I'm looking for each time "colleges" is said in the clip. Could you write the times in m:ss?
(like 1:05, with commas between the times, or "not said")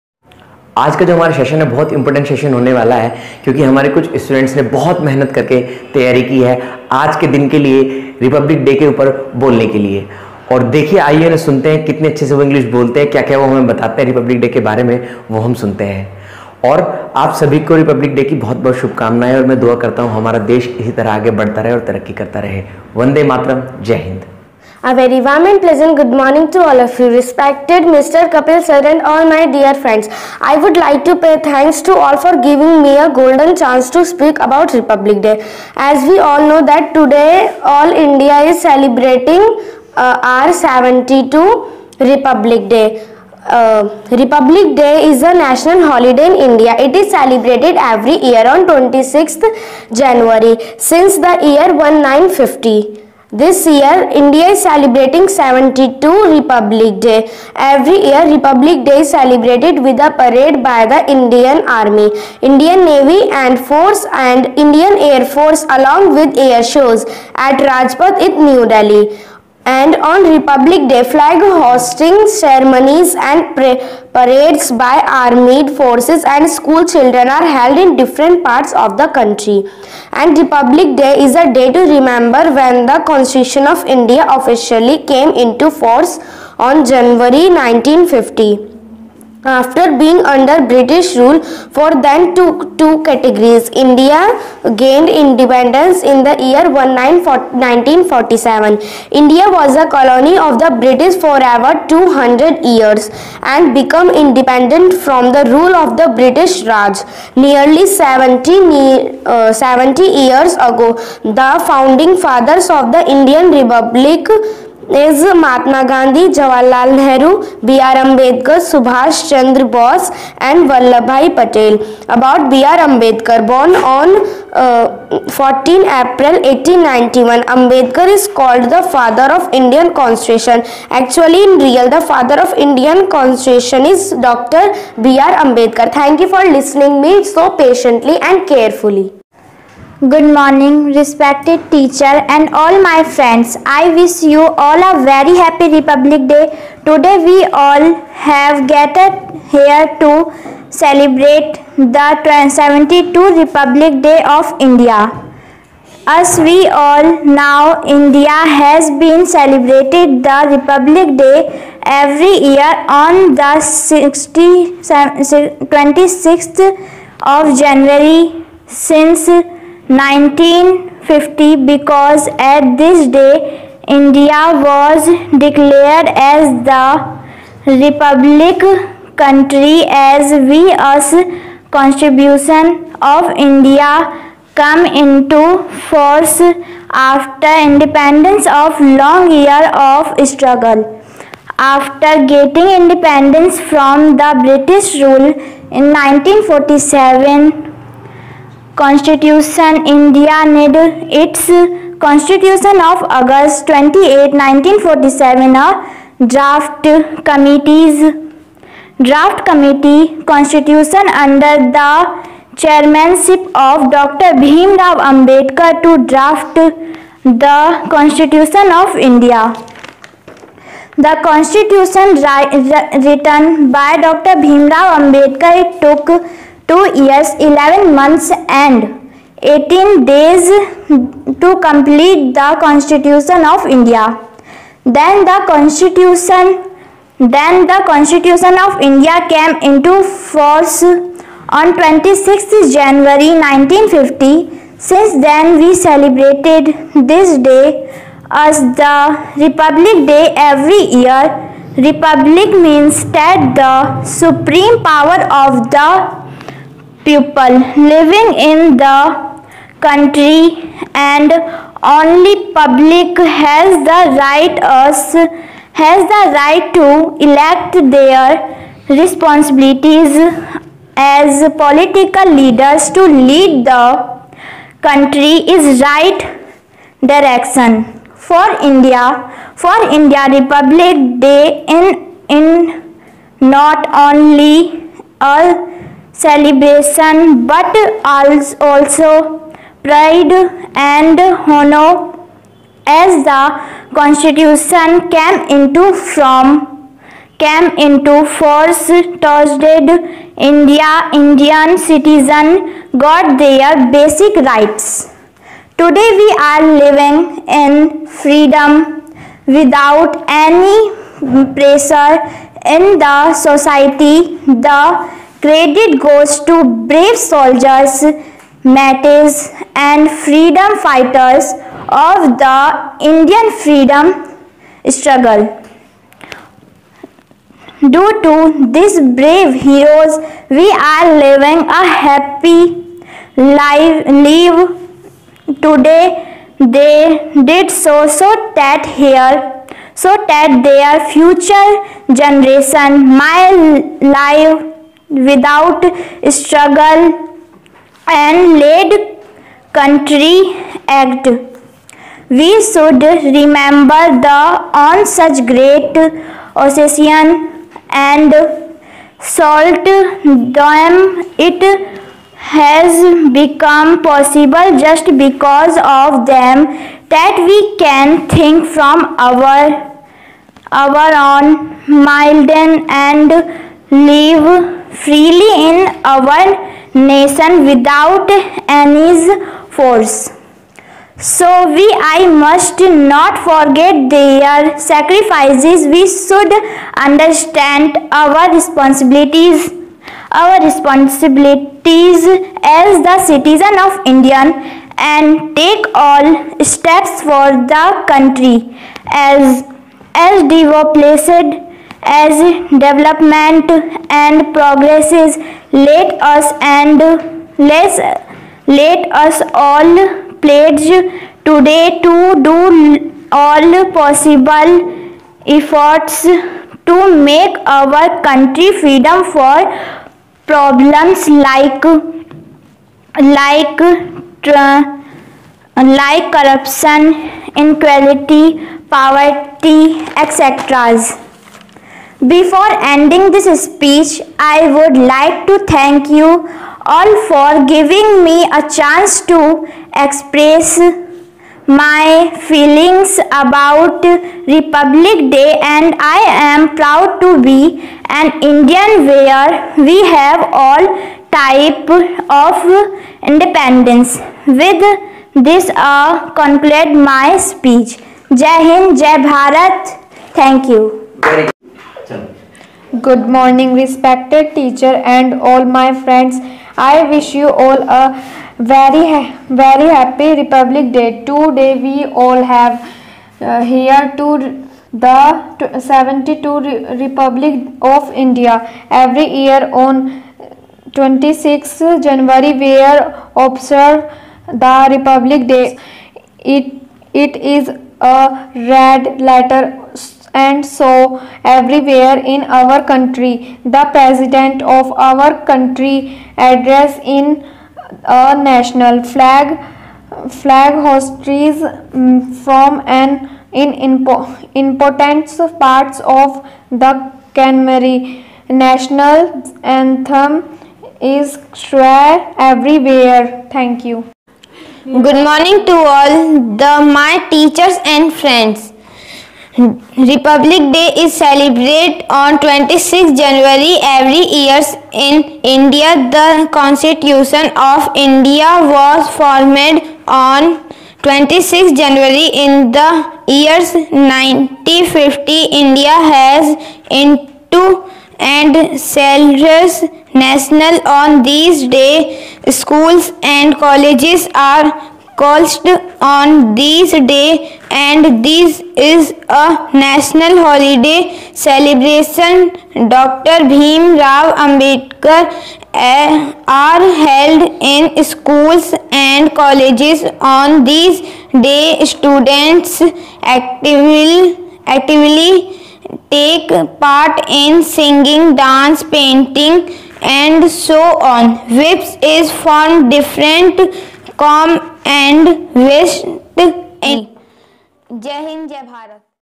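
9:03, 9:19.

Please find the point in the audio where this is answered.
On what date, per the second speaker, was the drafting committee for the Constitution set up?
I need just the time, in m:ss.
3:23.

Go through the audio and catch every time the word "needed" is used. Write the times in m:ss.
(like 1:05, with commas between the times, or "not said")
3:20.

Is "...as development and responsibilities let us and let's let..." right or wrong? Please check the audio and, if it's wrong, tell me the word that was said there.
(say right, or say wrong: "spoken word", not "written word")
wrong: "progresses", not "responsibilities".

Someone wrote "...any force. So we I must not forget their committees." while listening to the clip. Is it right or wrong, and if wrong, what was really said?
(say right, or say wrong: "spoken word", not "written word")
wrong: "sacrifices", not "committees".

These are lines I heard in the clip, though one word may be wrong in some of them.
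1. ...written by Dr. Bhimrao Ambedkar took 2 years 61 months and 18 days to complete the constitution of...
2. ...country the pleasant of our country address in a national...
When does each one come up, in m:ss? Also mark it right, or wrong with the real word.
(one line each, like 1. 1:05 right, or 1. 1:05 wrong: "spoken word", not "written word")
1. 3:43 wrong: "11", not "61"
2. 8:12 wrong: "president", not "pleasant".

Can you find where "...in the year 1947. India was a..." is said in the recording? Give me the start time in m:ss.
1:36.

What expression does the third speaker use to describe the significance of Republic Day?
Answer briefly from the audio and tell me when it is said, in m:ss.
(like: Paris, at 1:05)
red letter, at 8:08.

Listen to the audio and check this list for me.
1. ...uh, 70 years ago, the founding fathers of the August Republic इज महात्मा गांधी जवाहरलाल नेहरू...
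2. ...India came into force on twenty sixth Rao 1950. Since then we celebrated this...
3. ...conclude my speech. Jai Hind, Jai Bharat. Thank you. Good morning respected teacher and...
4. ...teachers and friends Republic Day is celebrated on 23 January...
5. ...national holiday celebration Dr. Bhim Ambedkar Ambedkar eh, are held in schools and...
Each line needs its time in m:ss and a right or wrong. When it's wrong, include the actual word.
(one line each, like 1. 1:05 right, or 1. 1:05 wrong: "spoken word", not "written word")
1. 1:49 wrong: "Indian", not "August"
2. 3:58 wrong: "January", not "Rao"
3. 7:36 right
4. 8:37 wrong: "26", not "23"
5. 9:09 wrong: "Rao", not "Ambedkar".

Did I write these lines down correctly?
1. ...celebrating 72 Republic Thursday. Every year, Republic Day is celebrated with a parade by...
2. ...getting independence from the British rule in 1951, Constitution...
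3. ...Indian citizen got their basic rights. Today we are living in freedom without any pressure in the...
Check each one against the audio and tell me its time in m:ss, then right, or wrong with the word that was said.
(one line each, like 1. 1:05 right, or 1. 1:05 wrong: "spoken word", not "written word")
1. 0:54 wrong: "Day", not "Thursday"
2. 3:12 wrong: "1947", not "1951"
3. 5:01 right.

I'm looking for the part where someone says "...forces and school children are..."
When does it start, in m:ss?
1:15.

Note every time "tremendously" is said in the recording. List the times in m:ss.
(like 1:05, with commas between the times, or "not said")
not said.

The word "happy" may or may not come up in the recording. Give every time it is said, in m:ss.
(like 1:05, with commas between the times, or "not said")
2:25, 5:32, 7:49.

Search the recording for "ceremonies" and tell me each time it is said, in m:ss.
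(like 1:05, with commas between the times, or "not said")
1:12.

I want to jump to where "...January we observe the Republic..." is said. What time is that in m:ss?
8:02.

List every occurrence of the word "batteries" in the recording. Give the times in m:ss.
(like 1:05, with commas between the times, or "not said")
not said.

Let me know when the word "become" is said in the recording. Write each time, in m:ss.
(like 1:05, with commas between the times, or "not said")
1:43, 6:03.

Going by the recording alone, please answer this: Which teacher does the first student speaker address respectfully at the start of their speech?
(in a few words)
Mr. Kapil.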